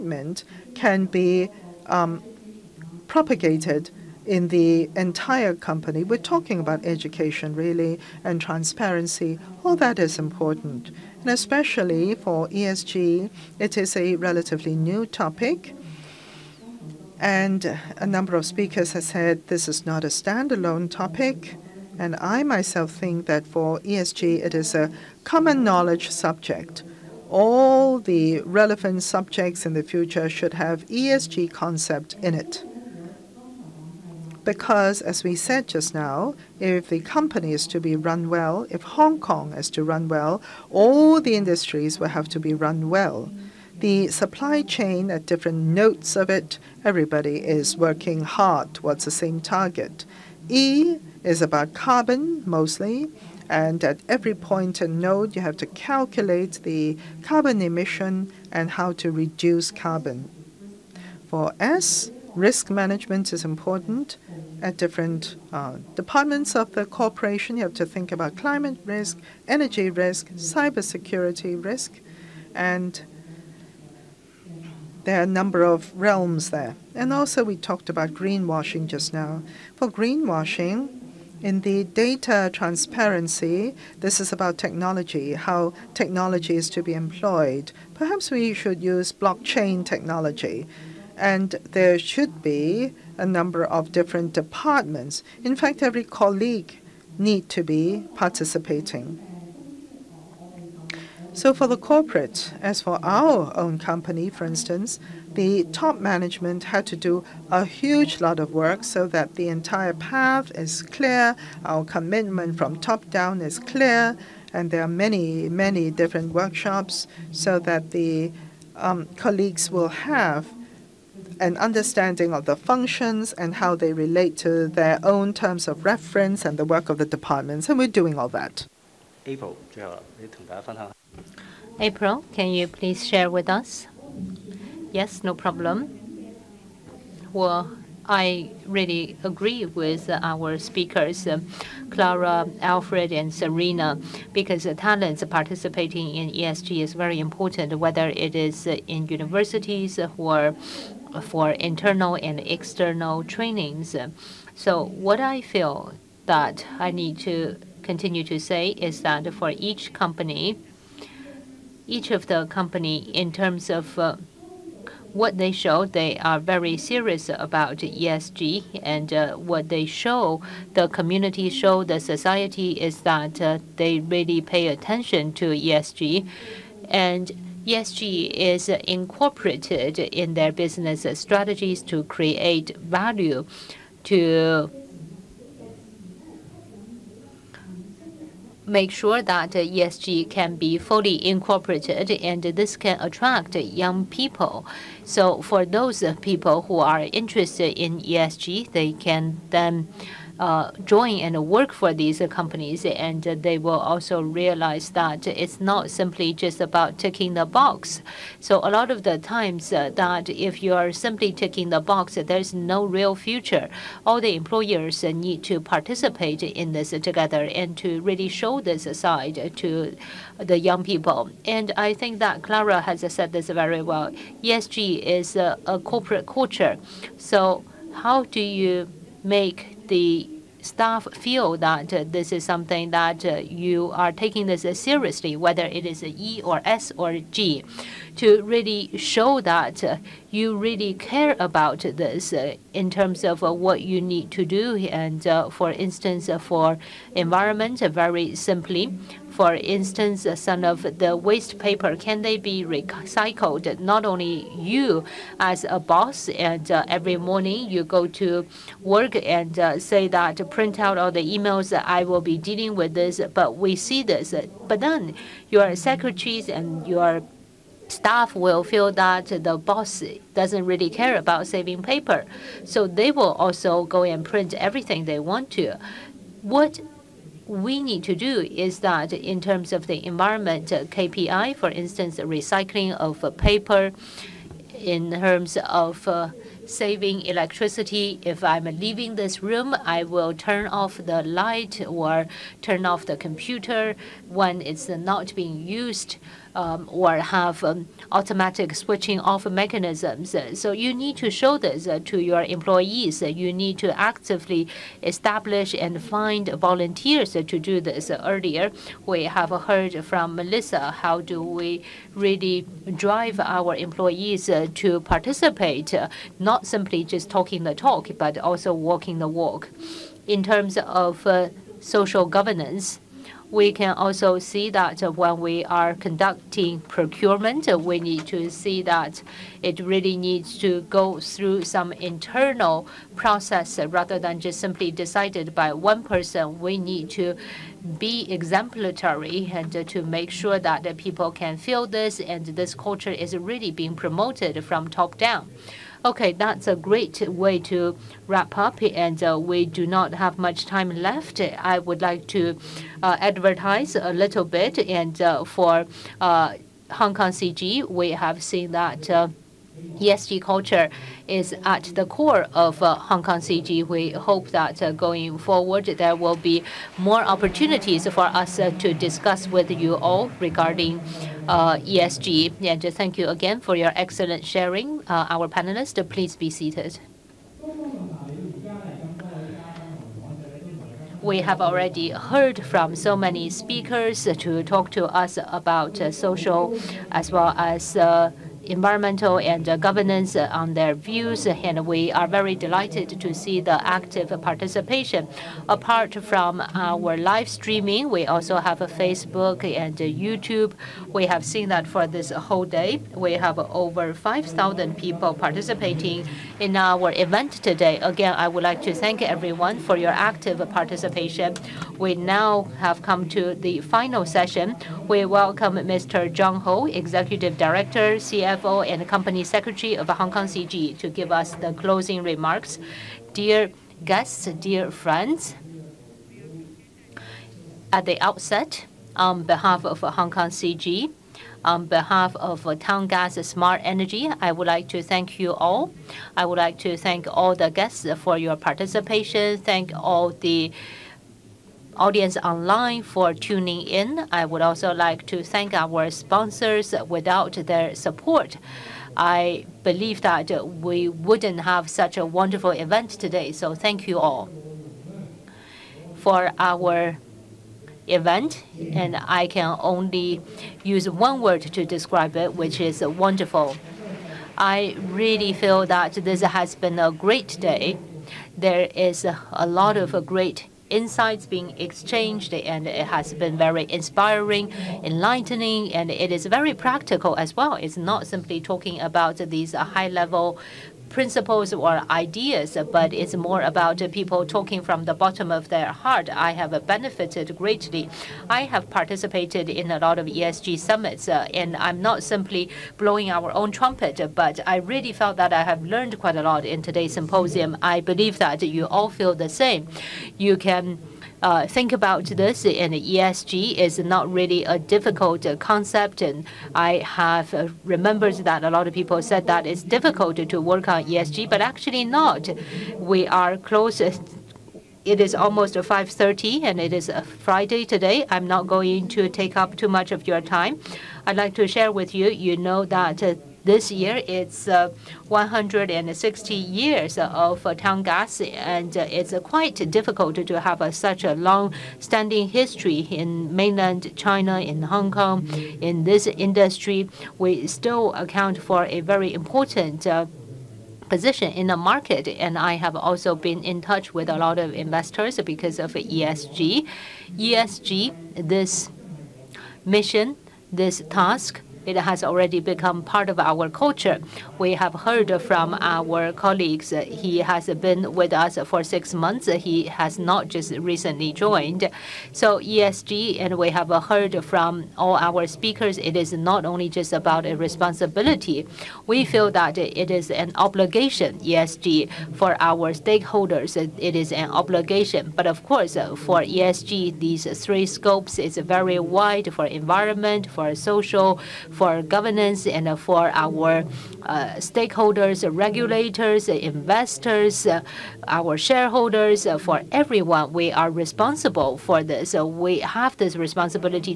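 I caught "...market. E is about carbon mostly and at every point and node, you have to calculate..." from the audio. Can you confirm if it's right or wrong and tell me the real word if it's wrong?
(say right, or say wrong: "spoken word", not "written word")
wrong: "target", not "market".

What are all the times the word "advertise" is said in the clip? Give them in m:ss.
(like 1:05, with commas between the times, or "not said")
5:53.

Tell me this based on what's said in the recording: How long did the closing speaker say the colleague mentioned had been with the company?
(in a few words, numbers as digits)
six months.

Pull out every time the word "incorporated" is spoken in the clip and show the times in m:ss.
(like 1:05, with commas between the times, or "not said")
2:58, 3:11.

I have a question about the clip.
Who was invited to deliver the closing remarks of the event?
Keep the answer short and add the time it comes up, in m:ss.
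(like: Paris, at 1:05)
John Ho, at 6:55.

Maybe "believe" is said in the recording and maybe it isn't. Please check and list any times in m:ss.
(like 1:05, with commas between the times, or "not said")
7:29, 8:18.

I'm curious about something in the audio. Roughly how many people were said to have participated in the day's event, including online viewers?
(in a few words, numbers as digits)
over 5,000.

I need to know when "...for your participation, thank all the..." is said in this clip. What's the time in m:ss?
7:18.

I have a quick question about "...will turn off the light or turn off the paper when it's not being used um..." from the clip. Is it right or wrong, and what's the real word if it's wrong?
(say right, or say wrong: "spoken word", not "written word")
wrong: "computer", not "paper".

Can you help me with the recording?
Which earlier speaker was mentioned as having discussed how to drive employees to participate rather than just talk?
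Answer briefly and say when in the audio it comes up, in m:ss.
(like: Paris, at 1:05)
Melissa, at 5:10.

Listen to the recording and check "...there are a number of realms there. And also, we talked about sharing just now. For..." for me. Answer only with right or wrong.
wrong.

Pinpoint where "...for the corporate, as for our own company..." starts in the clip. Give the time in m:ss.
1:41.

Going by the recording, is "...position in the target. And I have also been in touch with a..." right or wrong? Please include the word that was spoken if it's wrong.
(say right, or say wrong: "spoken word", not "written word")
wrong: "market", not "target".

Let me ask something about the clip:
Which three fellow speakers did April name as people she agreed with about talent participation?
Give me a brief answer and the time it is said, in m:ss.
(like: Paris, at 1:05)
Clara, Alfred, and Serena, at 2:21.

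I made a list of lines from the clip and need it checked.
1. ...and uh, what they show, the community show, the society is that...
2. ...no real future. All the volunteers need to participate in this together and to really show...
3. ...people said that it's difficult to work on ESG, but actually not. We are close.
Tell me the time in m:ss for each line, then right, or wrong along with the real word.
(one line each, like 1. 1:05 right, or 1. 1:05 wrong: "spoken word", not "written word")
1. 2:48 right
2. 3:32 wrong: "employers", not "volunteers"
3. 8:28 right.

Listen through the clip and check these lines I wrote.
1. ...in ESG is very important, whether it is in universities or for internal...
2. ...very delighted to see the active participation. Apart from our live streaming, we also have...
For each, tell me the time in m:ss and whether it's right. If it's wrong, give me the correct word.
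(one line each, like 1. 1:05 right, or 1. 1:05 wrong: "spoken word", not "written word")
1. 2:26 right
2. 6:32 right.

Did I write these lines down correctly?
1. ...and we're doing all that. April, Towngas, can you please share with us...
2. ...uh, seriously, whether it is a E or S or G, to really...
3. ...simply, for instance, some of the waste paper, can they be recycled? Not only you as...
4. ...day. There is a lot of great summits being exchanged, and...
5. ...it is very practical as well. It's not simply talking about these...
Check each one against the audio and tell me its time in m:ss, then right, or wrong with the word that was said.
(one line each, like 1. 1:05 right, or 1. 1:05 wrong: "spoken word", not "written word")
1. 2:07 wrong: "April", not "Towngas"
2. 3:54 right
3. 4:08 right
4. 7:47 wrong: "insights", not "summits"
5. 7:56 right.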